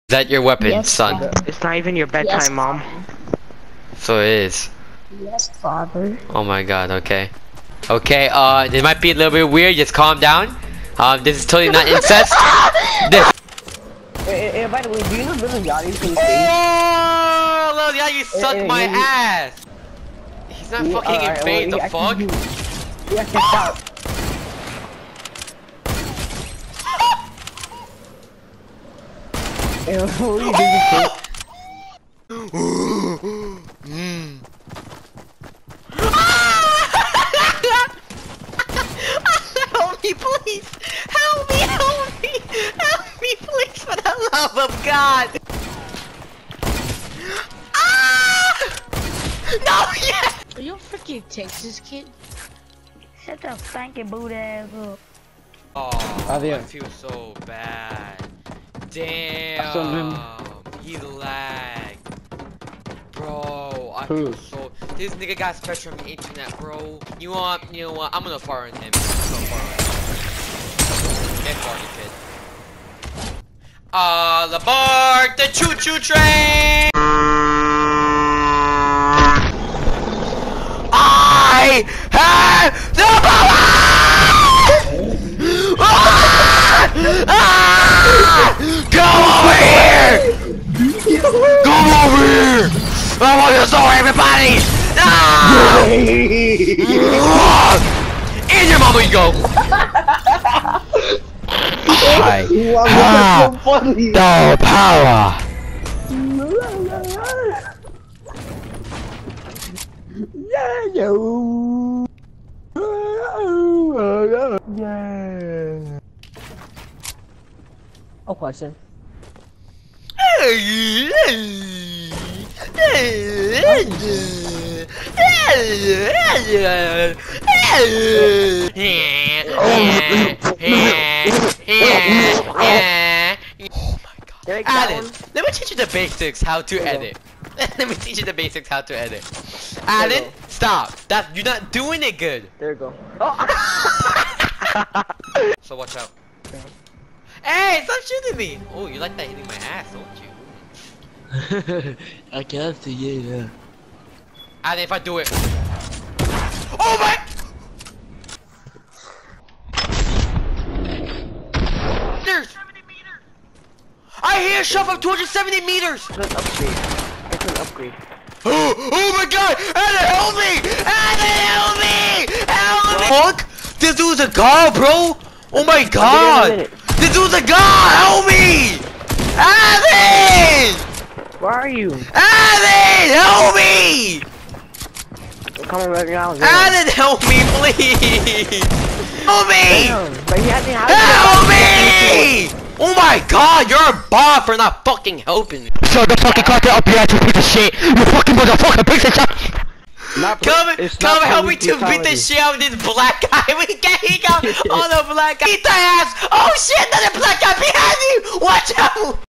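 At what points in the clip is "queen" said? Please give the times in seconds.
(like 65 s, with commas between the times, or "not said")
not said.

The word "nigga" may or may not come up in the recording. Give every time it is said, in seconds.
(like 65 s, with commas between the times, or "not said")
65 s.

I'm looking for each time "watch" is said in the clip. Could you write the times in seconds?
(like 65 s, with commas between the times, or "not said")
145 s, 208 s.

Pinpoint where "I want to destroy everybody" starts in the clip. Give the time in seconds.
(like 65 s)
93 s.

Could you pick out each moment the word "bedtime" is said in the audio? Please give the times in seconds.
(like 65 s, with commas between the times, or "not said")
2 s.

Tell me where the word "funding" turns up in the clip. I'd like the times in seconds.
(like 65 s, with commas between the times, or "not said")
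not said.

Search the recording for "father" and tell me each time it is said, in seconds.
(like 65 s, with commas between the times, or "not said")
1 s, 5 s.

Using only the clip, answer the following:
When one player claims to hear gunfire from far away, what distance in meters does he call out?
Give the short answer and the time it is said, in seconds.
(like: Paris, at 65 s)
270, at 164 s.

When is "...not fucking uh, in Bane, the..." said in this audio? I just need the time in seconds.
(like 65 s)
20 s.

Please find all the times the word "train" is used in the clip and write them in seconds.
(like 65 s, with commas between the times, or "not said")
75 s.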